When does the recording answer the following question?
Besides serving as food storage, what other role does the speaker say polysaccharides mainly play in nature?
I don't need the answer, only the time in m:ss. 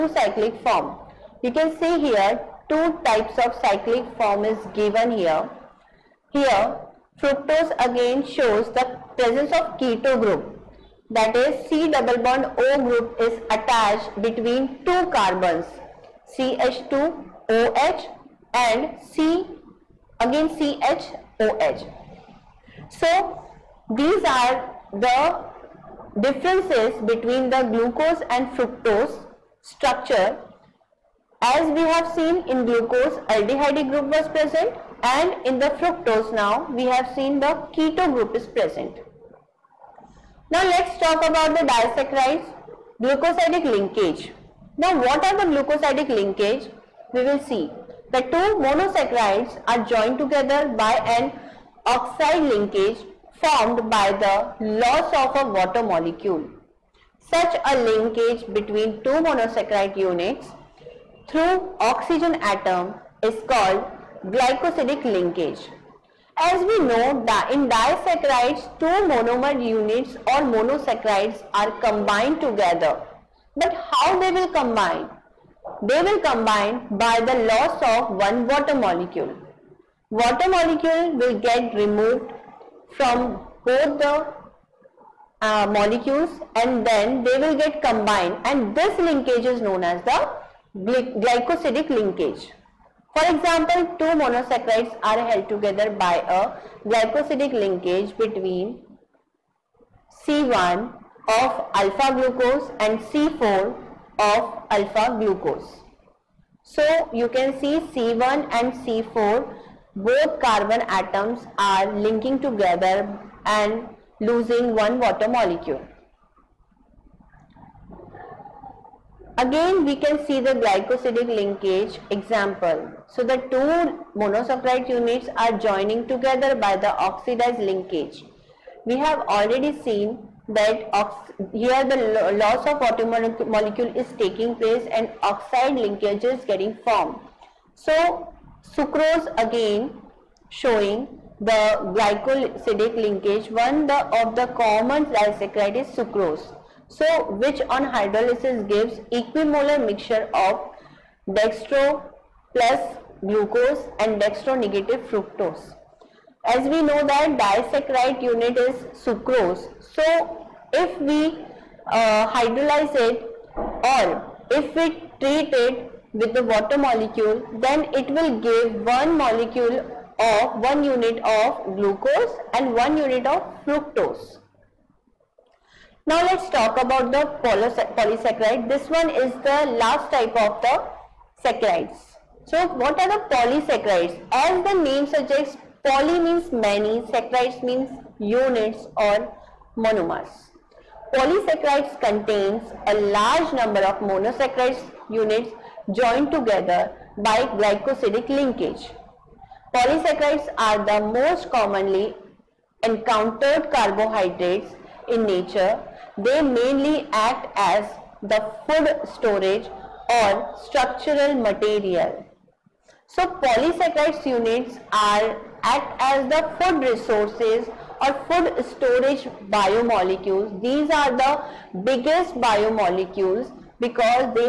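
3:30.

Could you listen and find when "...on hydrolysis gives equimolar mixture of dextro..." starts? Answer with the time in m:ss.
2:27.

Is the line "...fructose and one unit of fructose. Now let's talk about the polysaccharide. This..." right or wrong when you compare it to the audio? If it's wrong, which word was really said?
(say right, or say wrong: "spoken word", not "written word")
wrong: "glucose", not "fructose".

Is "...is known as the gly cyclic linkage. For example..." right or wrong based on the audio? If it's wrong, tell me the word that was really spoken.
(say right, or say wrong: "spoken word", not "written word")
wrong: "glycosidic", not "cyclic".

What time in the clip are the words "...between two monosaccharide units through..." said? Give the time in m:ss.
0:58.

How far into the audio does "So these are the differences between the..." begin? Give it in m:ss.
0:22.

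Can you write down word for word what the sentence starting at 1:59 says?
Again we can see the glycosidic linkage example.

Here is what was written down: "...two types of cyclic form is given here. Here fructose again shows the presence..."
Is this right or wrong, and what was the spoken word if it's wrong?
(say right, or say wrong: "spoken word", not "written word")
right.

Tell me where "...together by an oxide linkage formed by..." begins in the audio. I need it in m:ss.
0:50.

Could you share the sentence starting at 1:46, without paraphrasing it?
So you can see C1 and C4 both carbon atoms are linking together and losing one water molecule.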